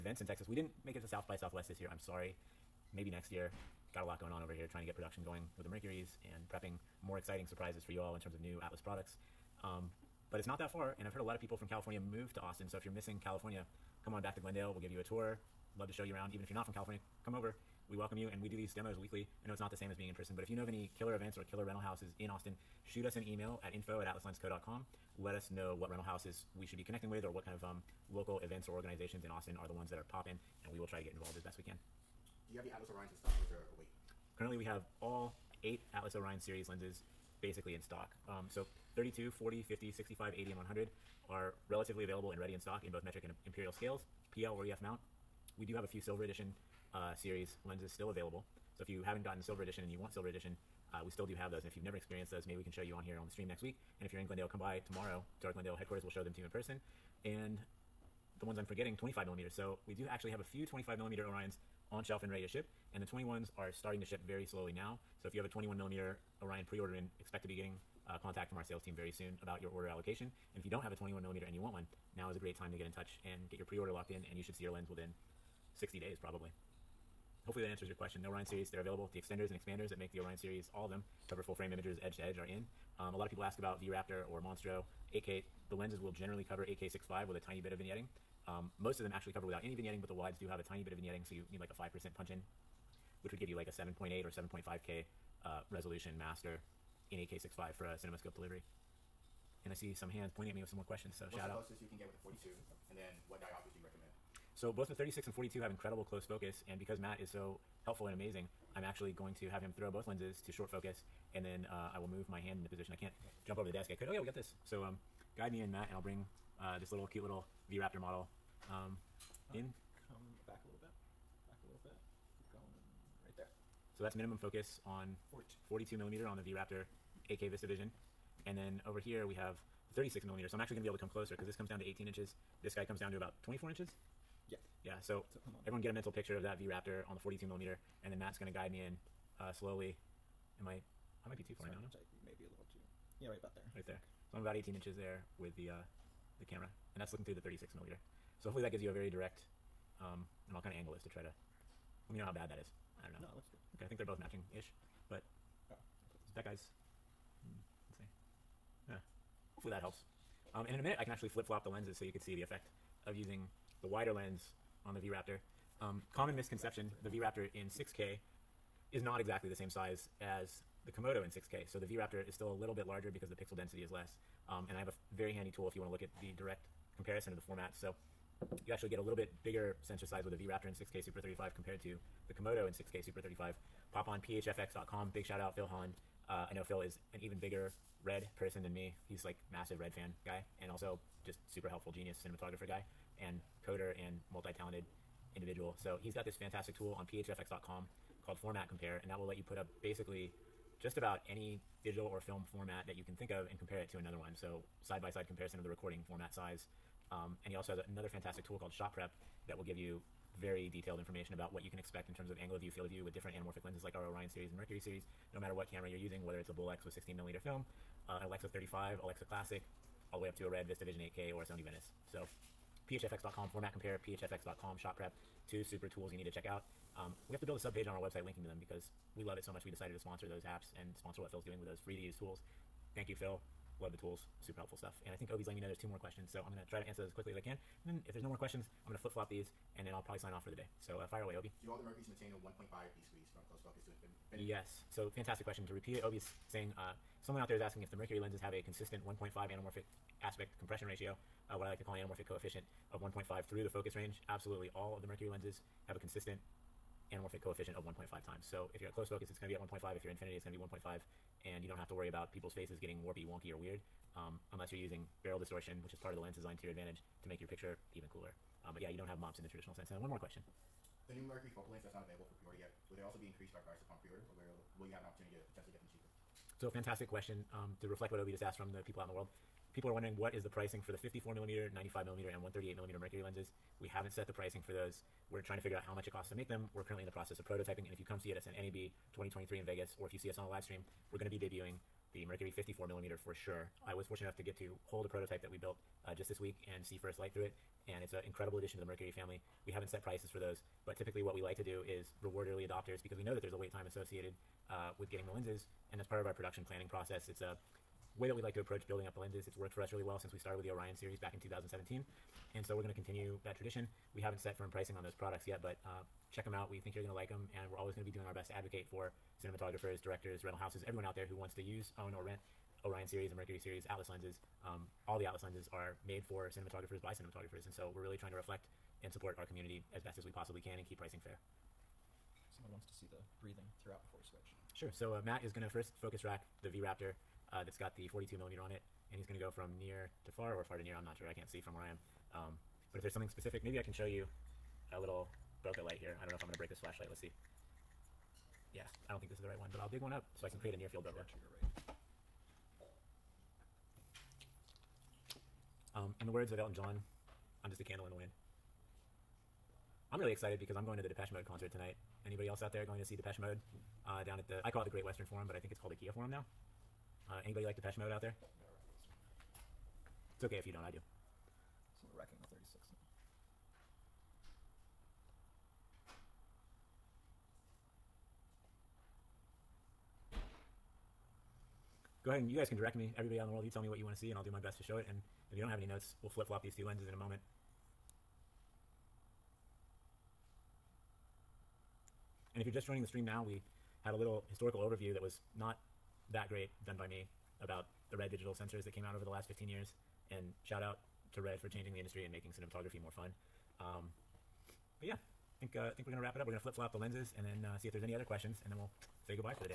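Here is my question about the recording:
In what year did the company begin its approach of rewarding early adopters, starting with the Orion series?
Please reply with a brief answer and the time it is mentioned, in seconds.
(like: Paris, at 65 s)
2017, at 311 s.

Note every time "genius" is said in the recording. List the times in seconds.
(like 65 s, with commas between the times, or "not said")
191 s.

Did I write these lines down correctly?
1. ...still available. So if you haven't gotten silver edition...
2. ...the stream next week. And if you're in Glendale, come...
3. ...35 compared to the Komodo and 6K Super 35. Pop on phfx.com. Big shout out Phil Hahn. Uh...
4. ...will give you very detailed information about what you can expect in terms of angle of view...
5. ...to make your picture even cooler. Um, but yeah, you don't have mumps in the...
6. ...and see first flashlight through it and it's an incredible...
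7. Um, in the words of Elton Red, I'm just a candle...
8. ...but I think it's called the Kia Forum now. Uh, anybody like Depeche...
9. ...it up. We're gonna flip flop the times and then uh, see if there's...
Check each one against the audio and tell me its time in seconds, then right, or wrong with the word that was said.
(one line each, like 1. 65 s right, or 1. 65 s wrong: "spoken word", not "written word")
1. 47 s right
2. 53 s right
3. 181 s right
4. 209 s right
5. 267 s right
6. 296 s wrong: "light", not "flashlight"
7. 355 s wrong: "John", not "Red"
8. 365 s right
9. 406 s wrong: "lenses", not "times".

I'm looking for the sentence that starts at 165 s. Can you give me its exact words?
Um, common misconception, the V-Raptor in 6K is not exactly the same size as the Komodo in 6K.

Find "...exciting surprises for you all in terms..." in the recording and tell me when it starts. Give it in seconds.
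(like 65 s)
7 s.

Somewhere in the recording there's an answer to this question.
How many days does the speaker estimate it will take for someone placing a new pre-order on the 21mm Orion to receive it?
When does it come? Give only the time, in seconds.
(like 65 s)
75 s.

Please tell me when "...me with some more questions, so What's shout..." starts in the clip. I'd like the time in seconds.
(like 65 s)
100 s.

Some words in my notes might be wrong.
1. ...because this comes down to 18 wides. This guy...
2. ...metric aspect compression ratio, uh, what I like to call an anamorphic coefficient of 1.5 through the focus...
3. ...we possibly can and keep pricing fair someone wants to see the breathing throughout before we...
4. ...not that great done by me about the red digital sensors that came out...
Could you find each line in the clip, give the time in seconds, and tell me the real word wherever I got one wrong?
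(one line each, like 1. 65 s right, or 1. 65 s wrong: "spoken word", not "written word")
1. 131 s wrong: "inches", not "wides"
2. 249 s wrong: "anamorphic", not "metric"
3. 330 s right
4. 395 s right.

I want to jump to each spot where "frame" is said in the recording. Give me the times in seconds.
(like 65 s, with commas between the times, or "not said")
81 s.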